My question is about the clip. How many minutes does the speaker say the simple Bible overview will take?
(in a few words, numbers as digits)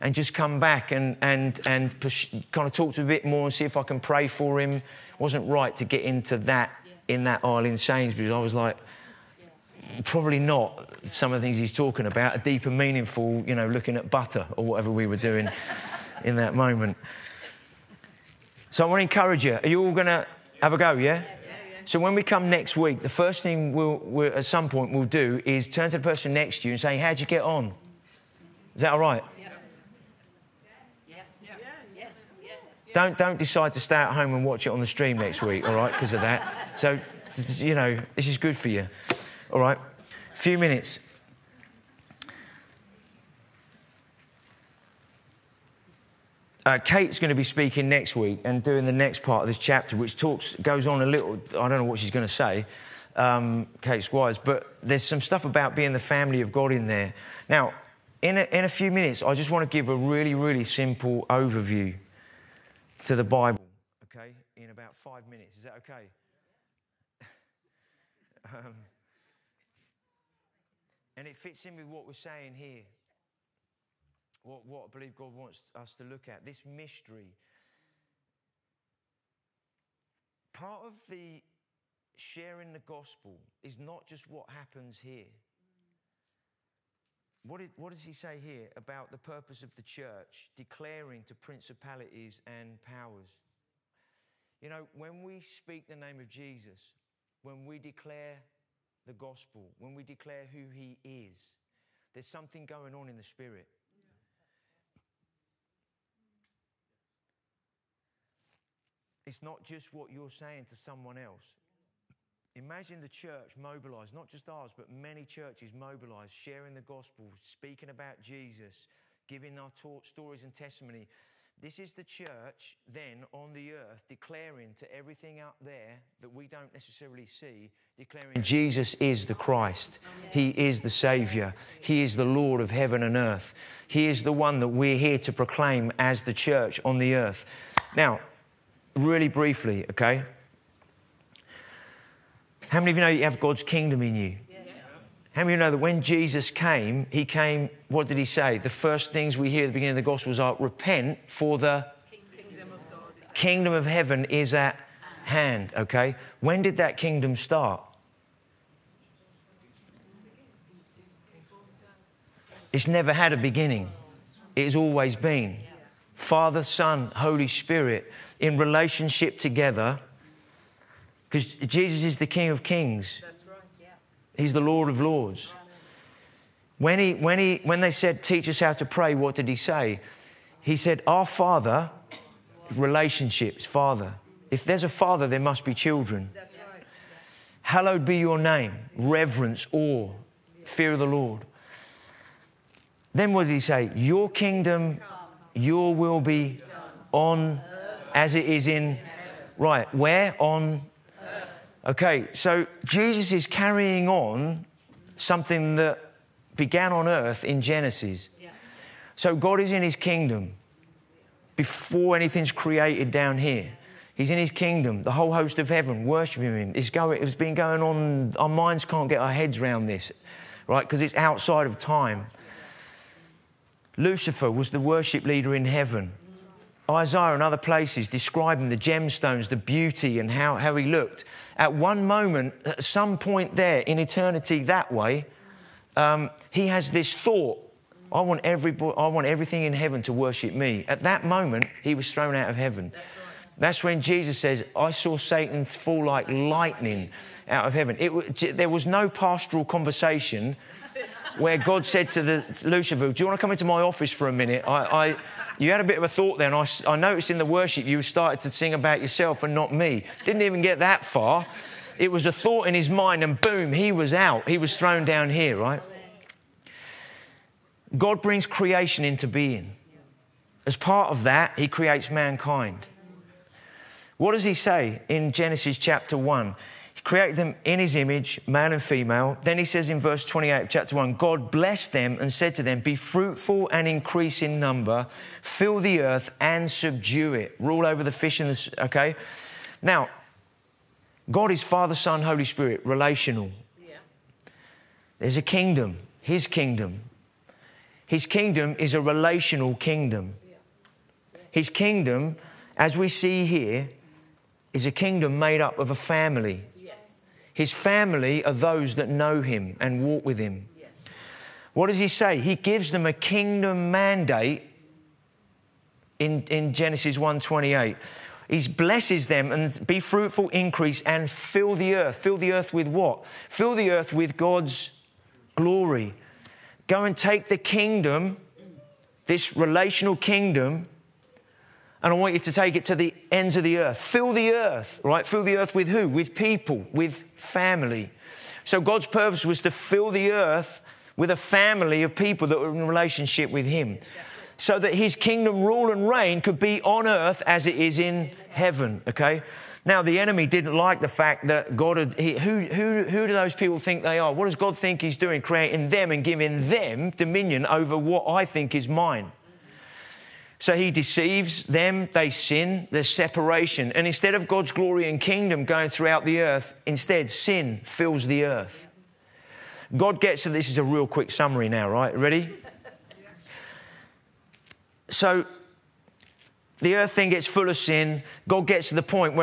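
5.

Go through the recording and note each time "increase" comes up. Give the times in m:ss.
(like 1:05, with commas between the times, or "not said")
4:43, 5:20.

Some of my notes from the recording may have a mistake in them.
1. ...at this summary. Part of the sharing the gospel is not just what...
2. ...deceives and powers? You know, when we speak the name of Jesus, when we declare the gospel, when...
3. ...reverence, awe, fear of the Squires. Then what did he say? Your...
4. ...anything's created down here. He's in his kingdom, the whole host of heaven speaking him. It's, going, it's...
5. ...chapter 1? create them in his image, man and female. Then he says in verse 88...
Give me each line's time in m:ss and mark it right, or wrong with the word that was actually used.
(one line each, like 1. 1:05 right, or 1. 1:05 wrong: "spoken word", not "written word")
1. 1:16 wrong: "mystery", not "summary"
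2. 1:31 wrong: "principalities", not "deceives"
3. 3:08 wrong: "Lord", not "Squires"
4. 3:32 wrong: "worshiping", not "speaking"
5. 4:35 wrong: "28", not "88".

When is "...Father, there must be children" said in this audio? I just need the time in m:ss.
3:04.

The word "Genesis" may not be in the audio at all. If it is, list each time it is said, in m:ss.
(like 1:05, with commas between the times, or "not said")
3:27, 4:35, 5:16.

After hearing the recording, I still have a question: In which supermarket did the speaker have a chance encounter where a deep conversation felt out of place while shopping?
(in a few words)
Sainsbury's.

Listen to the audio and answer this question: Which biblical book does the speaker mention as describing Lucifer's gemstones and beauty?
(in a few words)
Isaiah.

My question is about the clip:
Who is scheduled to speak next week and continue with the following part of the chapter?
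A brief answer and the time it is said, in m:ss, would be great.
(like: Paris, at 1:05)
Kate Squires, at 0:53.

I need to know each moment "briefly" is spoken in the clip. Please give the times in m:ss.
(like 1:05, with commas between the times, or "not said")
2:19.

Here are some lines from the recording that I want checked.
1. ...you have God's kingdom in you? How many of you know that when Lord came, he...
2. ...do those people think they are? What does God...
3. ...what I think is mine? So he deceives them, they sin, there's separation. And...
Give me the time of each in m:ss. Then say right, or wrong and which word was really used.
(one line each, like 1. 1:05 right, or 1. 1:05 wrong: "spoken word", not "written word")
1. 2:23 wrong: "Jesus", not "Lord"
2. 5:53 right
3. 5:57 right.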